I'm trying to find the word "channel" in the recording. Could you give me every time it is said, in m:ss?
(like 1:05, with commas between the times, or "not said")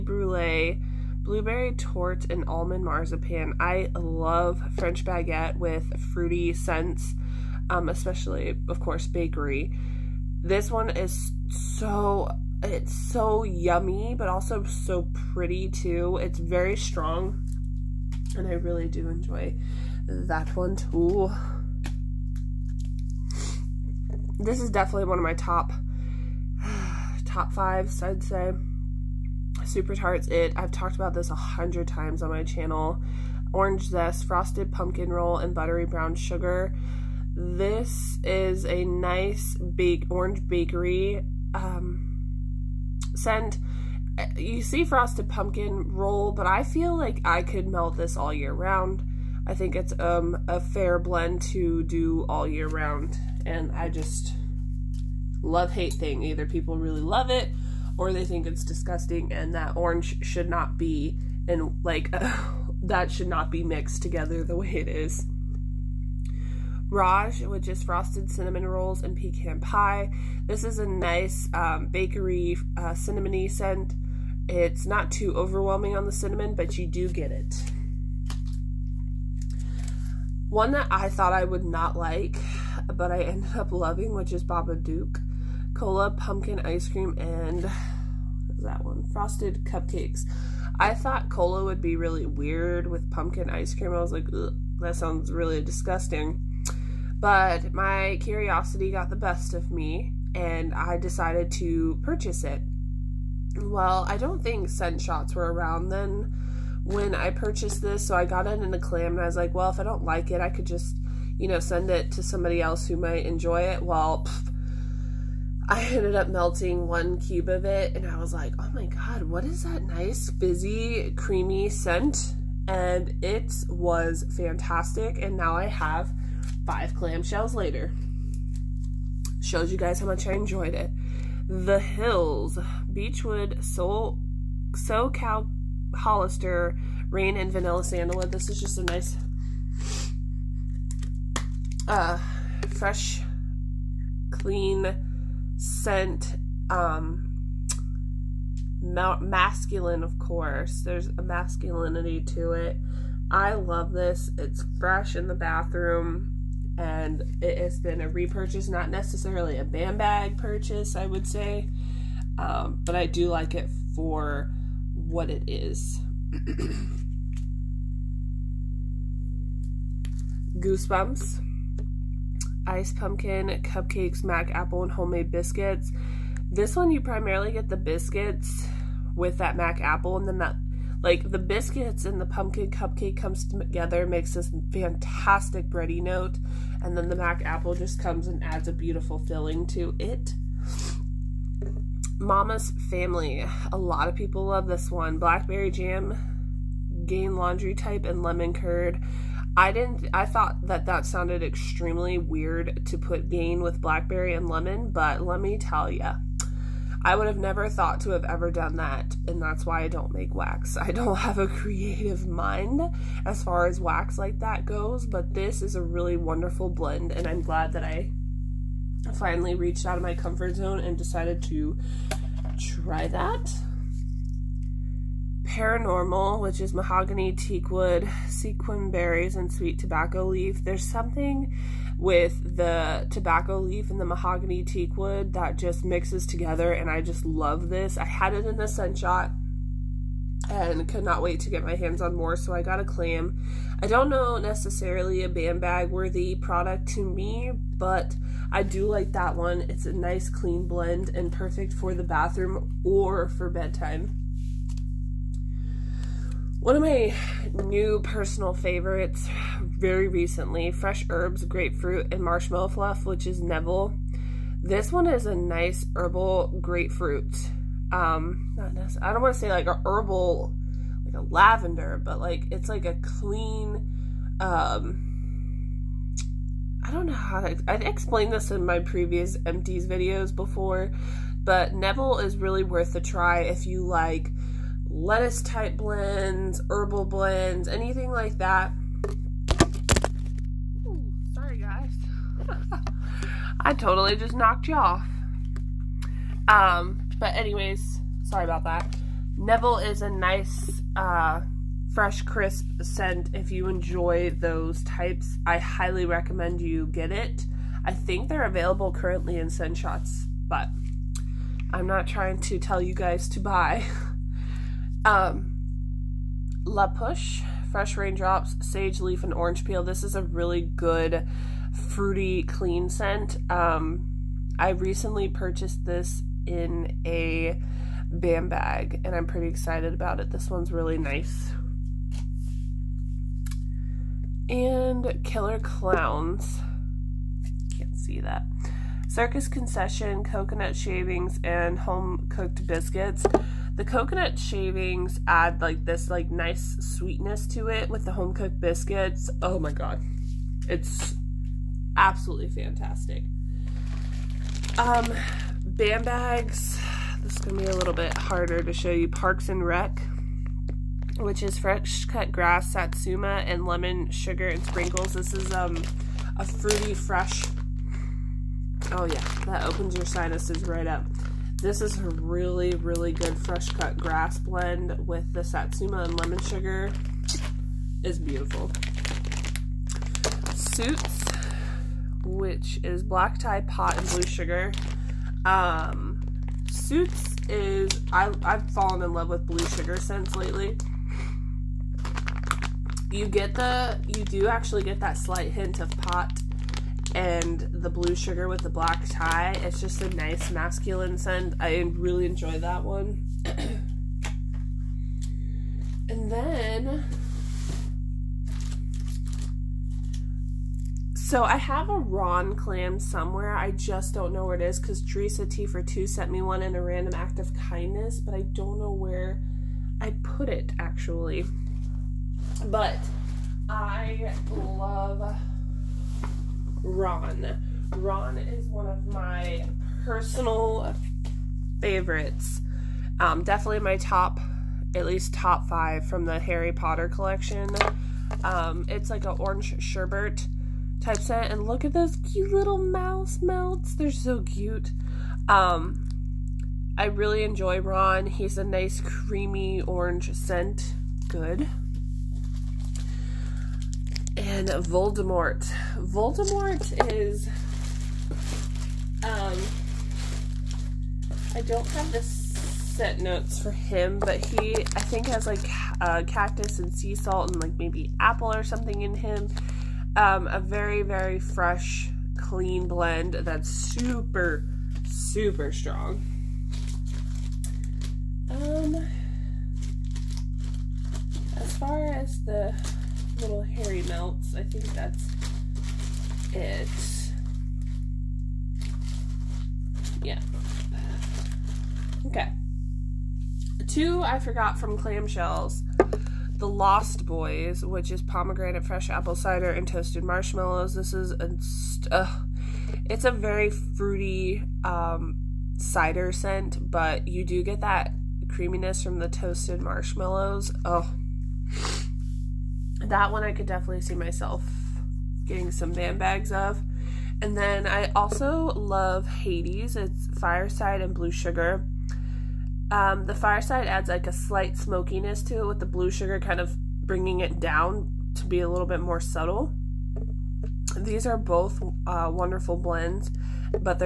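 0:32.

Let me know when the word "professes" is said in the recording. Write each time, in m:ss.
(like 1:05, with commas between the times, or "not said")
not said.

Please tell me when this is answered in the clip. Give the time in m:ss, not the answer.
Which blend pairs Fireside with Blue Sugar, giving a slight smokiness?
8:39.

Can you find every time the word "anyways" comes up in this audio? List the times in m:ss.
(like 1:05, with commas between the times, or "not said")
4:57.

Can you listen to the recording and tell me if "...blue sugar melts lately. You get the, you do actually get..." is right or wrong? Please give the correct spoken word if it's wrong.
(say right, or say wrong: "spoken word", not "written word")
wrong: "scents", not "melts".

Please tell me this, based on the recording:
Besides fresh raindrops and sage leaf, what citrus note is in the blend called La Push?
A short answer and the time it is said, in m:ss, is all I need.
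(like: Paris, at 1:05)
Orange Peel, at 5:19.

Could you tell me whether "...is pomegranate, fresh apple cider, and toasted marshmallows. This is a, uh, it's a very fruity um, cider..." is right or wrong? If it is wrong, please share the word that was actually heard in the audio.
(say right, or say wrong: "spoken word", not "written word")
right.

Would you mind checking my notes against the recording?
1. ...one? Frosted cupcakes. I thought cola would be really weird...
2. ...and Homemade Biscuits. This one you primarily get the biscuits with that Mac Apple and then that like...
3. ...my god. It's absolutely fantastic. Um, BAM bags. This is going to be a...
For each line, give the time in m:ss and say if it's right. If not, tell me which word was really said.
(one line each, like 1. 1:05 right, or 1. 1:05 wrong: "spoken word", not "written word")
1. 1:28 right
2. 2:54 right
3. 5:49 right.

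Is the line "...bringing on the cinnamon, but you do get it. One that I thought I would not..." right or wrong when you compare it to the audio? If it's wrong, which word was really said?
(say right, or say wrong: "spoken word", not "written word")
wrong: "overwhelming", not "bringing".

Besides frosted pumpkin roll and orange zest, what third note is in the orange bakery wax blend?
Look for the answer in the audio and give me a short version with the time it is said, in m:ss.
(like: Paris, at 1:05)
Buttery Brown Sugar, at 0:35.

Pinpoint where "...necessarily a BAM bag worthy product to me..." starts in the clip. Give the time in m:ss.
4:04.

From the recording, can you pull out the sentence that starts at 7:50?
Um, a very, very fresh, clean blend that's super, super strong.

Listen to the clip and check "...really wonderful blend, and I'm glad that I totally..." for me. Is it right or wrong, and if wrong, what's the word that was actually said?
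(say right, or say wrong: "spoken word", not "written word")
wrong: "finally", not "totally".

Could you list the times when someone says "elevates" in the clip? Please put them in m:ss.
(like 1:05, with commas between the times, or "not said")
not said.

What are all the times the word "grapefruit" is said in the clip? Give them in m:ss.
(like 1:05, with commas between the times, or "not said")
4:21, 4:26.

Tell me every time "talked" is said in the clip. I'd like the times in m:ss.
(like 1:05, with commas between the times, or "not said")
0:30.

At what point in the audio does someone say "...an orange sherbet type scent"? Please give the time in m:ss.
7:19.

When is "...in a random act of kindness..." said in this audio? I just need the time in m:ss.
6:56.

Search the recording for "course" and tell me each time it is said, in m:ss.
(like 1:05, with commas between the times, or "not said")
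0:08, 2:30.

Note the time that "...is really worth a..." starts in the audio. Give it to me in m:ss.
4:42.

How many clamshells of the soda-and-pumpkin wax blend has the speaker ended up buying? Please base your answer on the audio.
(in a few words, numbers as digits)
5.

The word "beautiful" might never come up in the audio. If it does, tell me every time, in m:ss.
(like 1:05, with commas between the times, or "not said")
3:08, 6:18.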